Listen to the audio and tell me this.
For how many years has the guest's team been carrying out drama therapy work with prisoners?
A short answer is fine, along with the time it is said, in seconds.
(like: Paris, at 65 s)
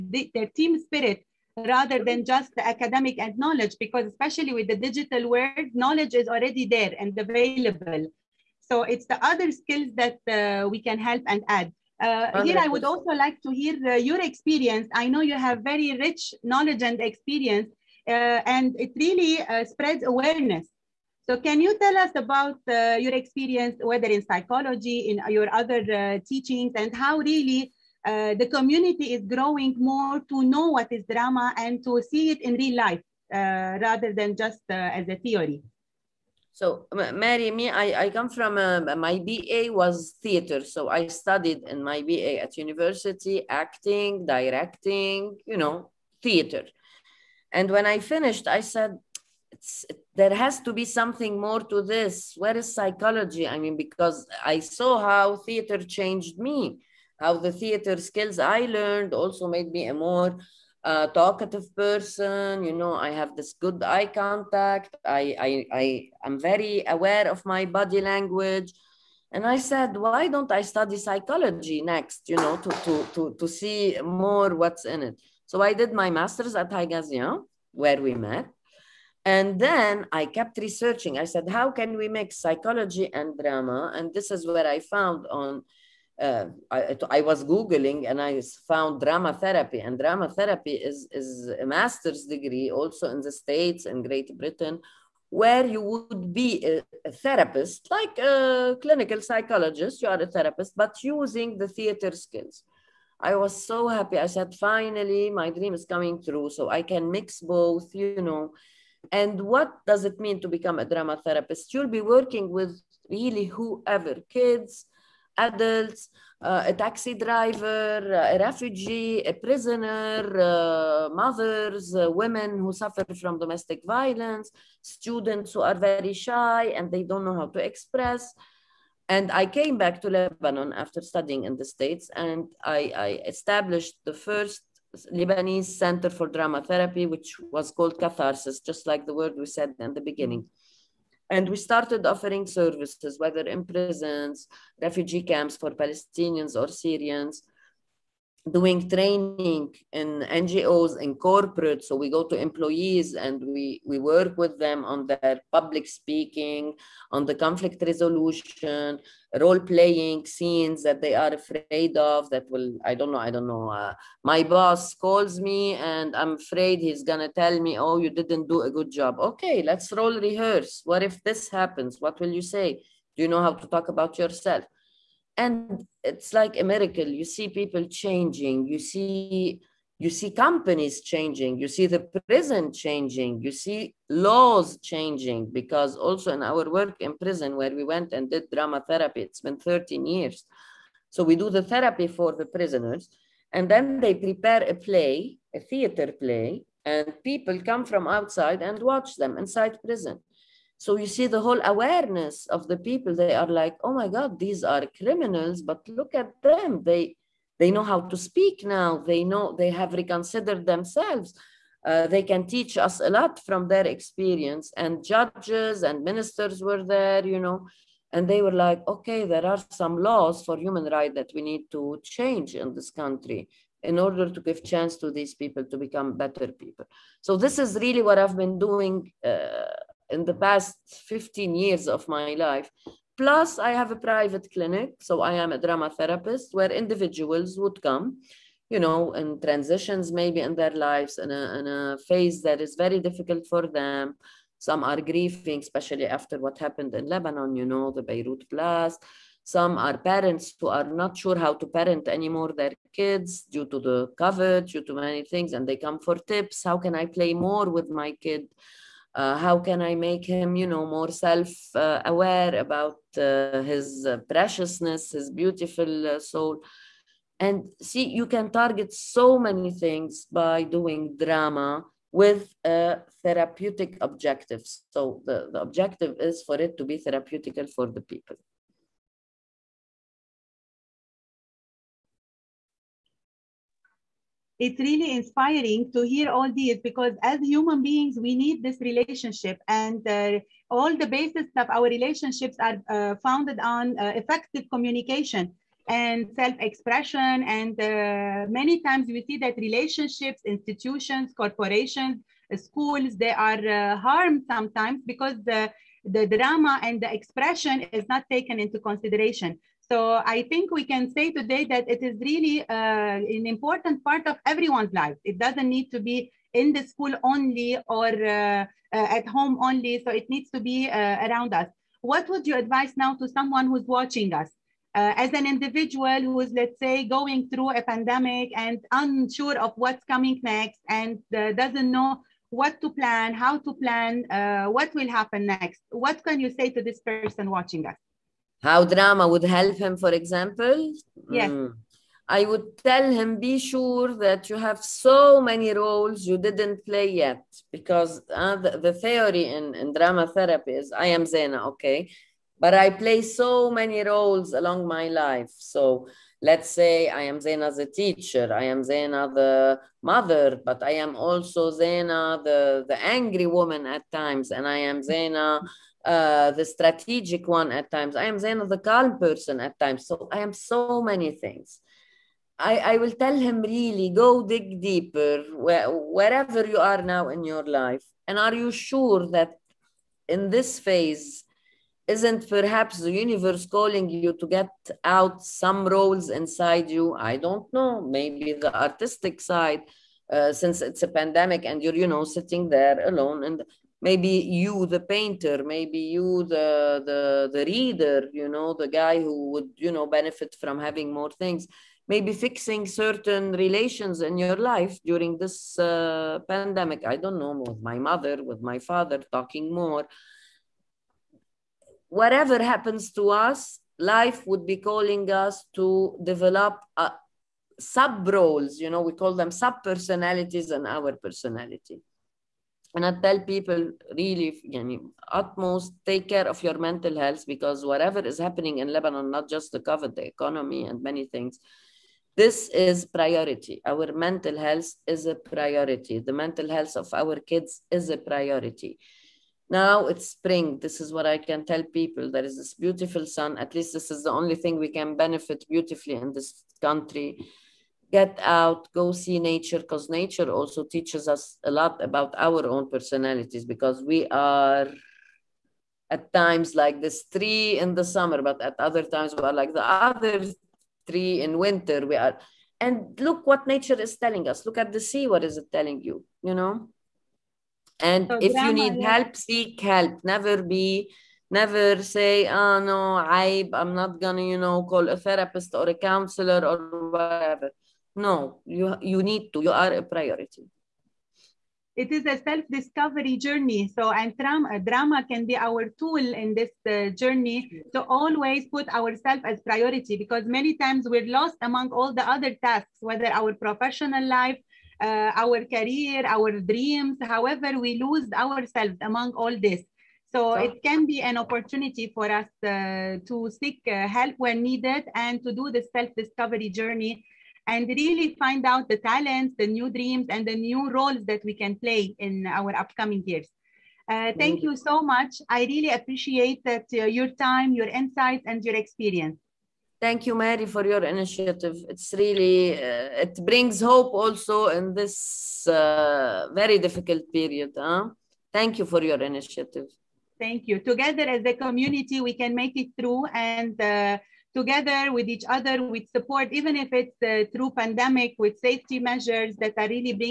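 13, at 189 s.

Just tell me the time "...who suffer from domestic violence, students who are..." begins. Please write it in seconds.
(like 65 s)
122 s.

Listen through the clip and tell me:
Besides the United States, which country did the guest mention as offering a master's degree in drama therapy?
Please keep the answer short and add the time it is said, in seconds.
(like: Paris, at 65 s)
Great Britain, at 94 s.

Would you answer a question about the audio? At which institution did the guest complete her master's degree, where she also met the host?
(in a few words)
Haigazian.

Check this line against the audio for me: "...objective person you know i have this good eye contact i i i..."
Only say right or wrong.
wrong.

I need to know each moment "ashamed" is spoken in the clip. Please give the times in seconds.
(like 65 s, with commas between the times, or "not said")
not said.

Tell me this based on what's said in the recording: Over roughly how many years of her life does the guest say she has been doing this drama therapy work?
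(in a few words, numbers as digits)
15.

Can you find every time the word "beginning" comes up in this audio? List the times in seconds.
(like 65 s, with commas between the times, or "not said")
140 s.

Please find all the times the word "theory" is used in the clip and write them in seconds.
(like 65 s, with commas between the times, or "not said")
35 s, 349 s.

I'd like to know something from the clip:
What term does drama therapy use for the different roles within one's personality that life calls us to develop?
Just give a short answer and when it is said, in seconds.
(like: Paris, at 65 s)
Sub personalities, at 419 s.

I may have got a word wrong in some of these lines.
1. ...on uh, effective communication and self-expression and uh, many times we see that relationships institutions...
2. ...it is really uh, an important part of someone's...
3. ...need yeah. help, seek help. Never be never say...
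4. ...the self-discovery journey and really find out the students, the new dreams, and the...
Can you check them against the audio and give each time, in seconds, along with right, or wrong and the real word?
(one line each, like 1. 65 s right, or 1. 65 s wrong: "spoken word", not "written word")
1. 293 s right
2. 311 s wrong: "everyone", not "someone"
3. 468 s right
4. 505 s wrong: "talents", not "students".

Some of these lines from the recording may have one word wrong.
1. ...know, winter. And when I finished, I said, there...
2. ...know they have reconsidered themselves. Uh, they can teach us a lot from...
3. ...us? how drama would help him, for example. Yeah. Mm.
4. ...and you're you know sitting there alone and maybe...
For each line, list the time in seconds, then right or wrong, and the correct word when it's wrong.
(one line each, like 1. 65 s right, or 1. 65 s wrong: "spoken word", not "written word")
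1. 45 s wrong: "theater", not "winter"
2. 209 s right
3. 337 s right
4. 391 s right.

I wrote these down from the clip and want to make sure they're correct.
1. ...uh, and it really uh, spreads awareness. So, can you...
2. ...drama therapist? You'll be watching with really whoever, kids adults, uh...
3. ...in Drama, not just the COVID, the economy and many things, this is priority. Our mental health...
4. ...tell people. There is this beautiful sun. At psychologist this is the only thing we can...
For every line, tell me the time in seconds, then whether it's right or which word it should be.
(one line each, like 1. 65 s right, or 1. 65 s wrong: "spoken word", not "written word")
1. 18 s right
2. 110 s wrong: "working", not "watching"
3. 428 s wrong: "Lebanon", not "Drama"
4. 441 s wrong: "least", not "psychologist".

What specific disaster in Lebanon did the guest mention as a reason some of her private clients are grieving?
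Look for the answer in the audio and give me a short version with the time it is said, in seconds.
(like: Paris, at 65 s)
Beirut blast, at 248 s.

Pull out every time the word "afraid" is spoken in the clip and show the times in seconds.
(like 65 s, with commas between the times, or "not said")
161 s, 166 s.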